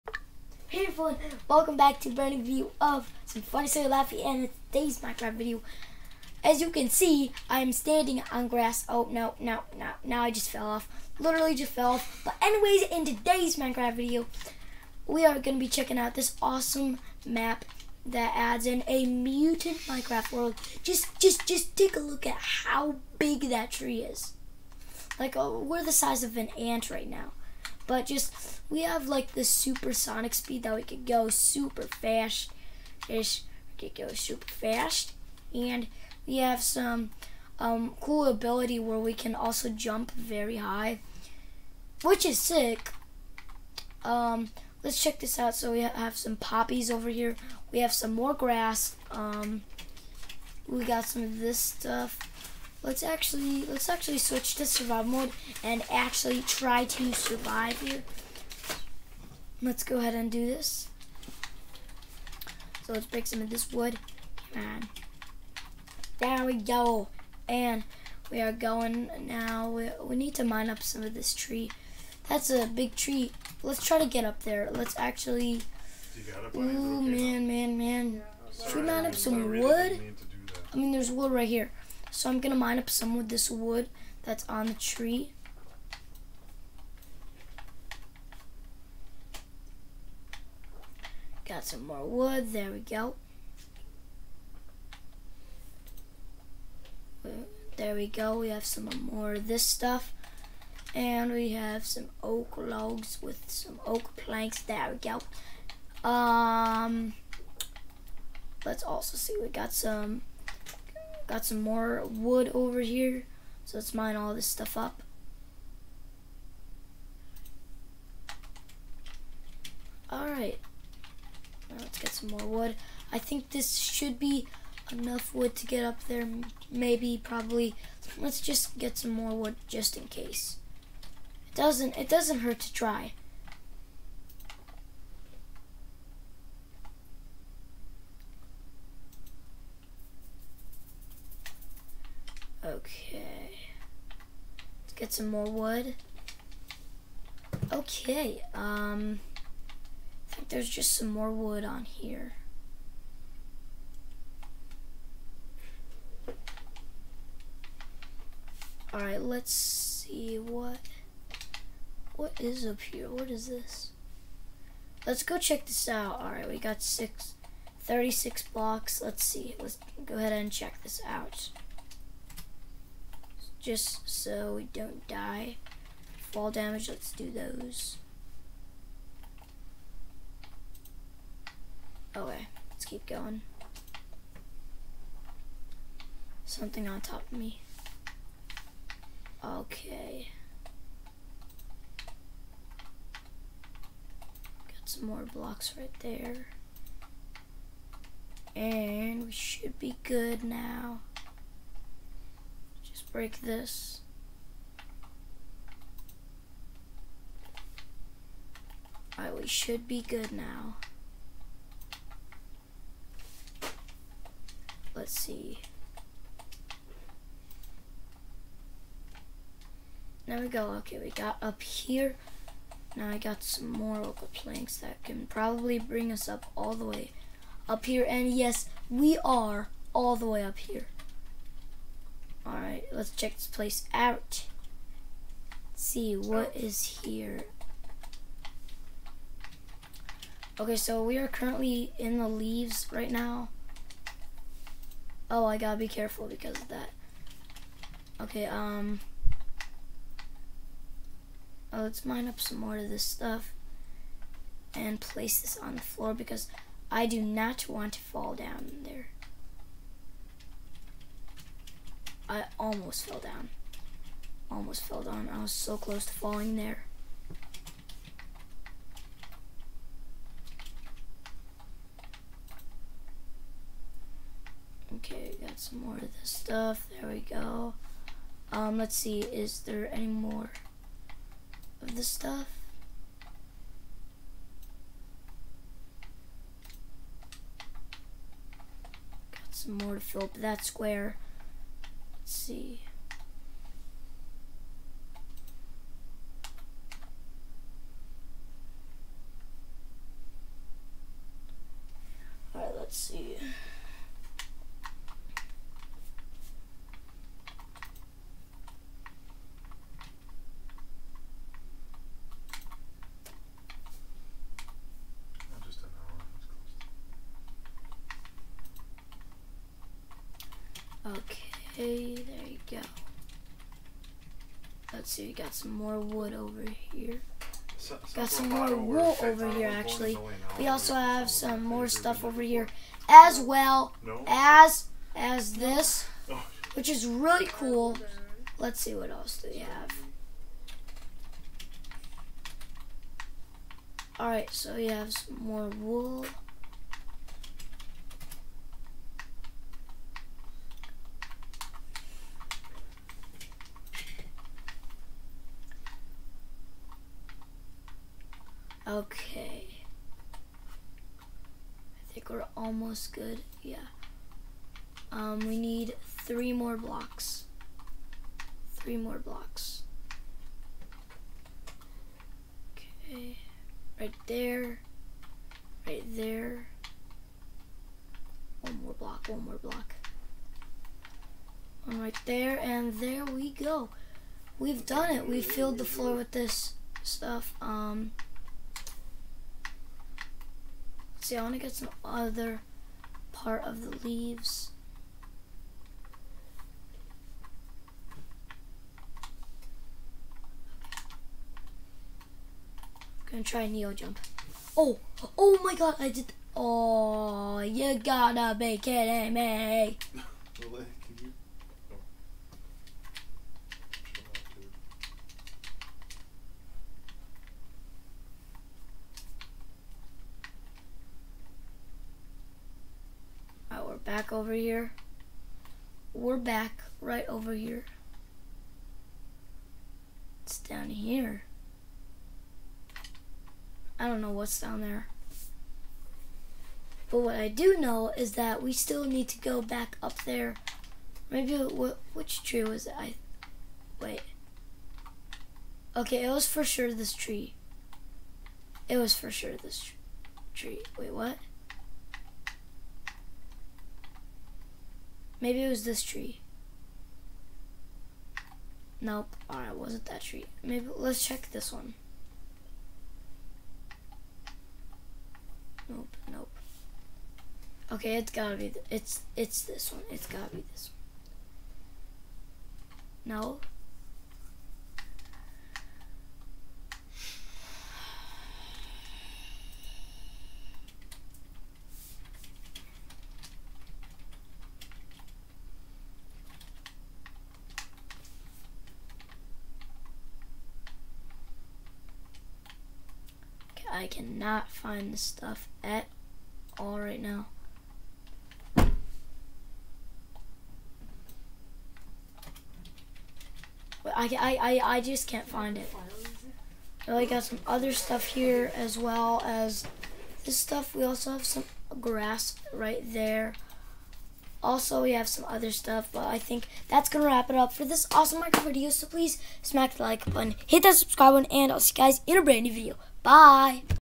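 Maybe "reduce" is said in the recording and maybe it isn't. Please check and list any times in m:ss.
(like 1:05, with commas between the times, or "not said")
not said.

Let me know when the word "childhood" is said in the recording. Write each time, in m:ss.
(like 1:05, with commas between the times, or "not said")
not said.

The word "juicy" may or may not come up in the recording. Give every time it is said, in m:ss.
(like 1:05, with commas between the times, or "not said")
not said.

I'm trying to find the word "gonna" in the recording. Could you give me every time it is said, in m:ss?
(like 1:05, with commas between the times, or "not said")
0:15, 6:43.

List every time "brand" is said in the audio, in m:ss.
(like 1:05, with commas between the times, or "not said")
0:02, 8:42.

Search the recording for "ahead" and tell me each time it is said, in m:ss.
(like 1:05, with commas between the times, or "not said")
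0:59, 2:50.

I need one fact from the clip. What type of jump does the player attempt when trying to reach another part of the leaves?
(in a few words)
neo jump.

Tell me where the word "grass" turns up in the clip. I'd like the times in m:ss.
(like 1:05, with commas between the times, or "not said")
0:08, 0:48, 8:31.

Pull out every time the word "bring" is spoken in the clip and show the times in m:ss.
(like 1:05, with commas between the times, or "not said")
3:45.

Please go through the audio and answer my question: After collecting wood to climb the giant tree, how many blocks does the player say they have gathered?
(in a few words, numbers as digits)
36.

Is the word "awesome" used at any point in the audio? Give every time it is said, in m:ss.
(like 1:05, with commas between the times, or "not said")
0:16, 8:38.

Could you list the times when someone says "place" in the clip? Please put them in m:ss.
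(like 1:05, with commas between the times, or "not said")
3:53, 4:14.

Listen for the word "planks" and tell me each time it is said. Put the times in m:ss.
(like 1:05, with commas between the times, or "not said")
1:44, 3:44.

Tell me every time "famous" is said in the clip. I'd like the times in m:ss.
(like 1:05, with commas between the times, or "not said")
not said.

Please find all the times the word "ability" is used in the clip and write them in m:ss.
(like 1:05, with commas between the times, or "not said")
0:38.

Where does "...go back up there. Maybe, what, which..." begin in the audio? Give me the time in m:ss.
7:19.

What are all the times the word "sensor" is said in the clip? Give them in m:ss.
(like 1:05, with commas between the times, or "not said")
not said.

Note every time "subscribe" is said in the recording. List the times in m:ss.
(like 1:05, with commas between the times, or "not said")
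8:40.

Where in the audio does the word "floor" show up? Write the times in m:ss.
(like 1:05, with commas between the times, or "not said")
4:15, 6:25.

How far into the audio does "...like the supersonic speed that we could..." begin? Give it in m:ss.
0:29.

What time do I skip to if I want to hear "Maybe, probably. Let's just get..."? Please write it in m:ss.
2:06.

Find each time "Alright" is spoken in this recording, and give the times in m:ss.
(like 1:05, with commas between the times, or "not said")
2:00, 2:38, 2:46, 3:29, 3:52, 5:02, 5:44, 7:39.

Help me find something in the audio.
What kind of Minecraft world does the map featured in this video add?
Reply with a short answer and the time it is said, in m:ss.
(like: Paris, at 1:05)
mutant Minecraft world, at 0:19.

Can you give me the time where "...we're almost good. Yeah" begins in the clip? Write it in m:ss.
6:02.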